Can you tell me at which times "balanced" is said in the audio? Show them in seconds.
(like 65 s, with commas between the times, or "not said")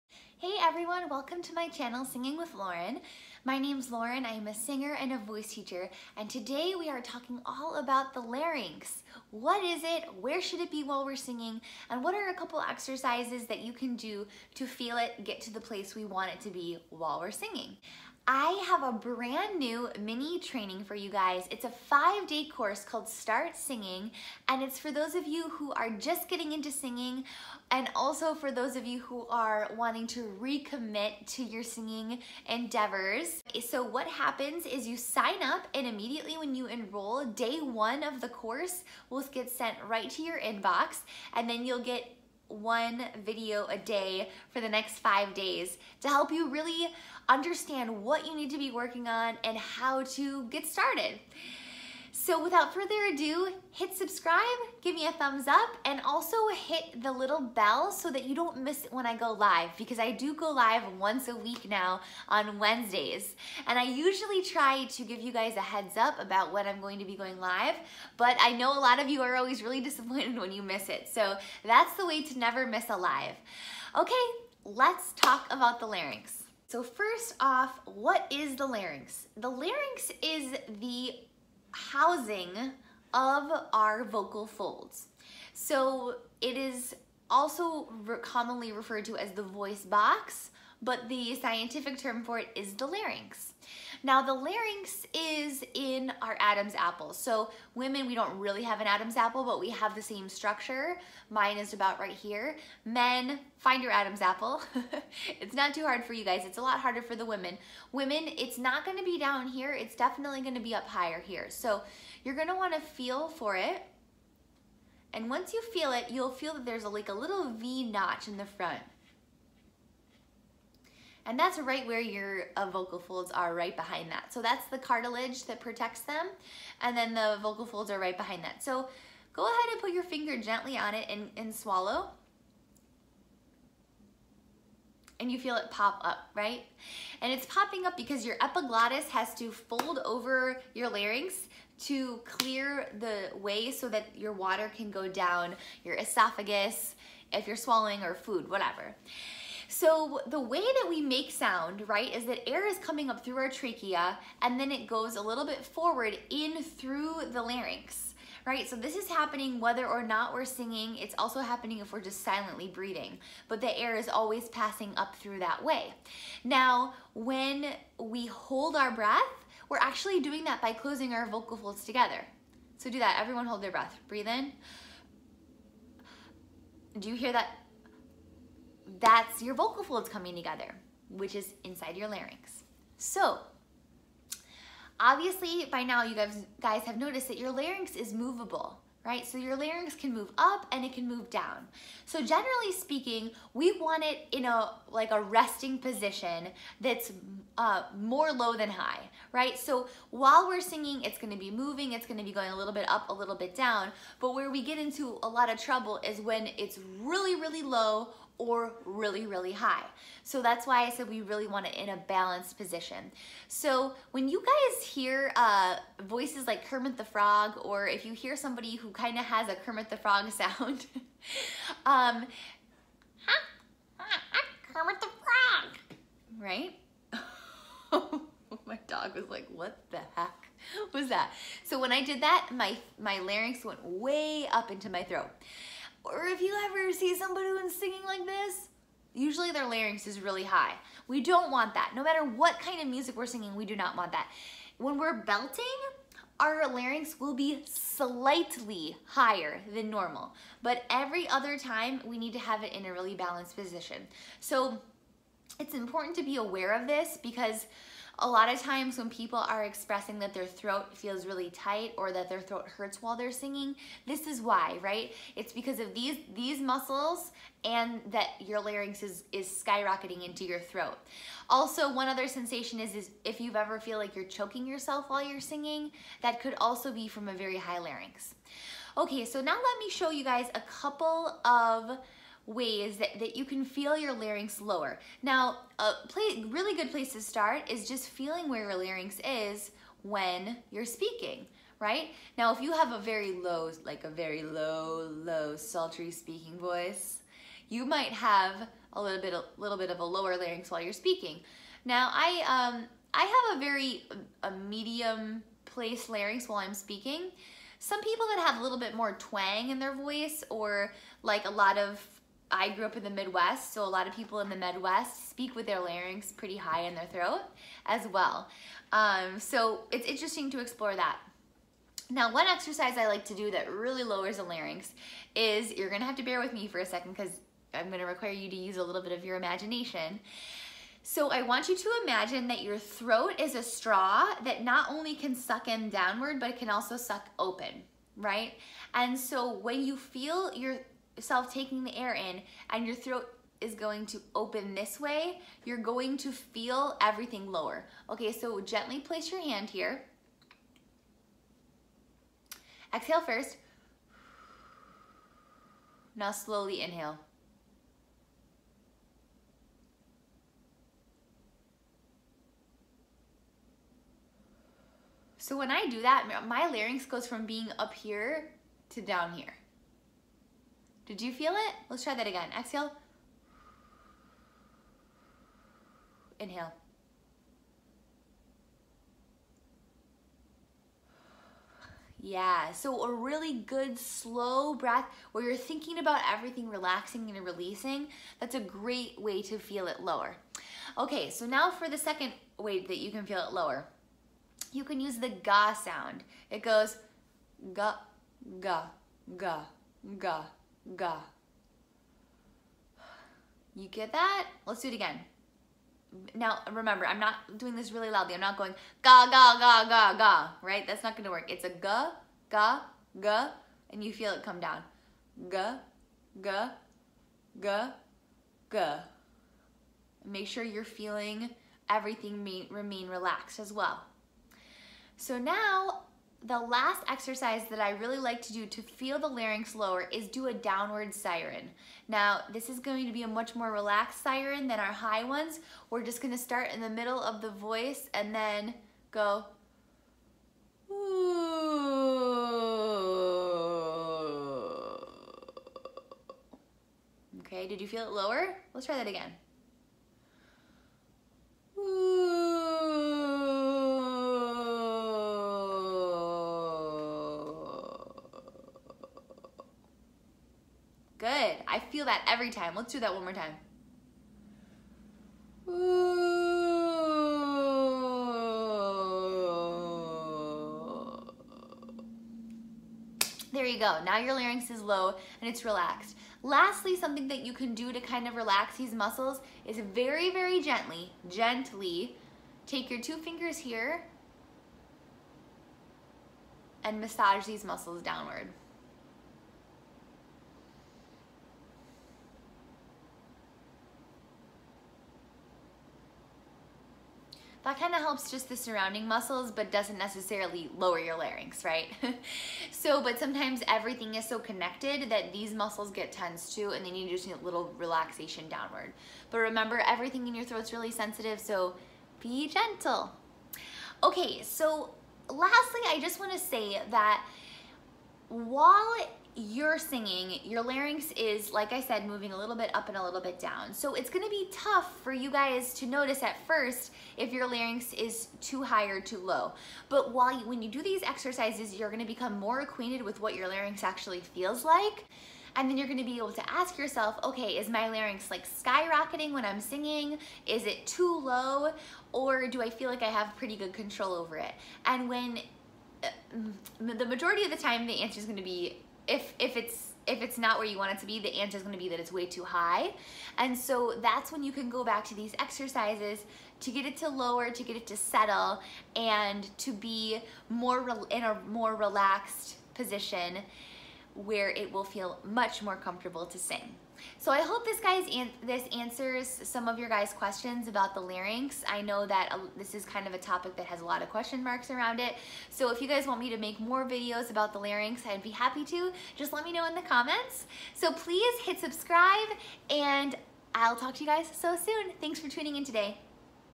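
212 s, 253 s.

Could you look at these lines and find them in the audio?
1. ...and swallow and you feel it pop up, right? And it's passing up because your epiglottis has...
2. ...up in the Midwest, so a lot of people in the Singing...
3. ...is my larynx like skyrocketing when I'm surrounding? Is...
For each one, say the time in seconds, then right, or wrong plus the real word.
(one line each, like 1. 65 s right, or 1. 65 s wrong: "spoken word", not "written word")
1. 131 s wrong: "popping", not "passing"
2. 312 s wrong: "Midwest", not "Singing"
3. 537 s wrong: "singing", not "surrounding".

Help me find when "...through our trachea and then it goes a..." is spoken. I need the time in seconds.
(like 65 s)
153 s.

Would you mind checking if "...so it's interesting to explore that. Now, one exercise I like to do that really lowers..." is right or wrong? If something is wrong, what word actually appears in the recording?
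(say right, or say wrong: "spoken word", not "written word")
right.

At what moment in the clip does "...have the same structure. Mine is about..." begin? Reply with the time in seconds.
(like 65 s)
99 s.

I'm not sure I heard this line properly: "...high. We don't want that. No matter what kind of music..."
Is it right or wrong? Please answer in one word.
right.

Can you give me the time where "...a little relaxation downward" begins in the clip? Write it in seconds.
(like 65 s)
507 s.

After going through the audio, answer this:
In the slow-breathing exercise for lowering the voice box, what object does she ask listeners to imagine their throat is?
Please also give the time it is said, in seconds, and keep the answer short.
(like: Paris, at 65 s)
A straw, at 333 s.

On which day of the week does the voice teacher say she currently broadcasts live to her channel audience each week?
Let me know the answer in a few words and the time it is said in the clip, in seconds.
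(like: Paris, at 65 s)
Wednesdays, at 62 s.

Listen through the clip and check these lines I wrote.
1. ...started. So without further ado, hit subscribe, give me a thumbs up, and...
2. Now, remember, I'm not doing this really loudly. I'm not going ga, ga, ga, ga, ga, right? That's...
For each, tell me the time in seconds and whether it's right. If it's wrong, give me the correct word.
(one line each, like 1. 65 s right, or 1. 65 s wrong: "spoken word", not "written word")
1. 50 s right
2. 406 s right.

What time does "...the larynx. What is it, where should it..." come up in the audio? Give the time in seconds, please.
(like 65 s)
8 s.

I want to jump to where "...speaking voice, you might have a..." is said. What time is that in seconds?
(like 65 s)
296 s.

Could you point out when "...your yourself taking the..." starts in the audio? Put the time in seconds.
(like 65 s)
340 s.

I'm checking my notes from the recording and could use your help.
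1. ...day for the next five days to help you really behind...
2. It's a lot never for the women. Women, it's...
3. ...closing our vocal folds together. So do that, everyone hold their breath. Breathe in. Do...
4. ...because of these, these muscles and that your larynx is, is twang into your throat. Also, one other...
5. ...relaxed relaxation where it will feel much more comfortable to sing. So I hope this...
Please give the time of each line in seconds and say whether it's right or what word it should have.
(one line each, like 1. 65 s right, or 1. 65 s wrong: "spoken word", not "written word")
1. 43 s wrong: "understand", not "behind"
2. 106 s wrong: "harder", not "never"
3. 170 s right
4. 265 s wrong: "skyrocketing", not "twang"
5. 561 s wrong: "position", not "relaxation".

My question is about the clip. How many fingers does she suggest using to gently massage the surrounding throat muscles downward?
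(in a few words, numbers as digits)
2.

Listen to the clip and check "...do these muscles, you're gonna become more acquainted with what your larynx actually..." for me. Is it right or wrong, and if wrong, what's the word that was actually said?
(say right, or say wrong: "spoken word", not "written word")
wrong: "exercises", not "muscles".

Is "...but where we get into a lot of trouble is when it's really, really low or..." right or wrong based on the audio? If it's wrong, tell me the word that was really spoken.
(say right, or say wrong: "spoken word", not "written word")
right.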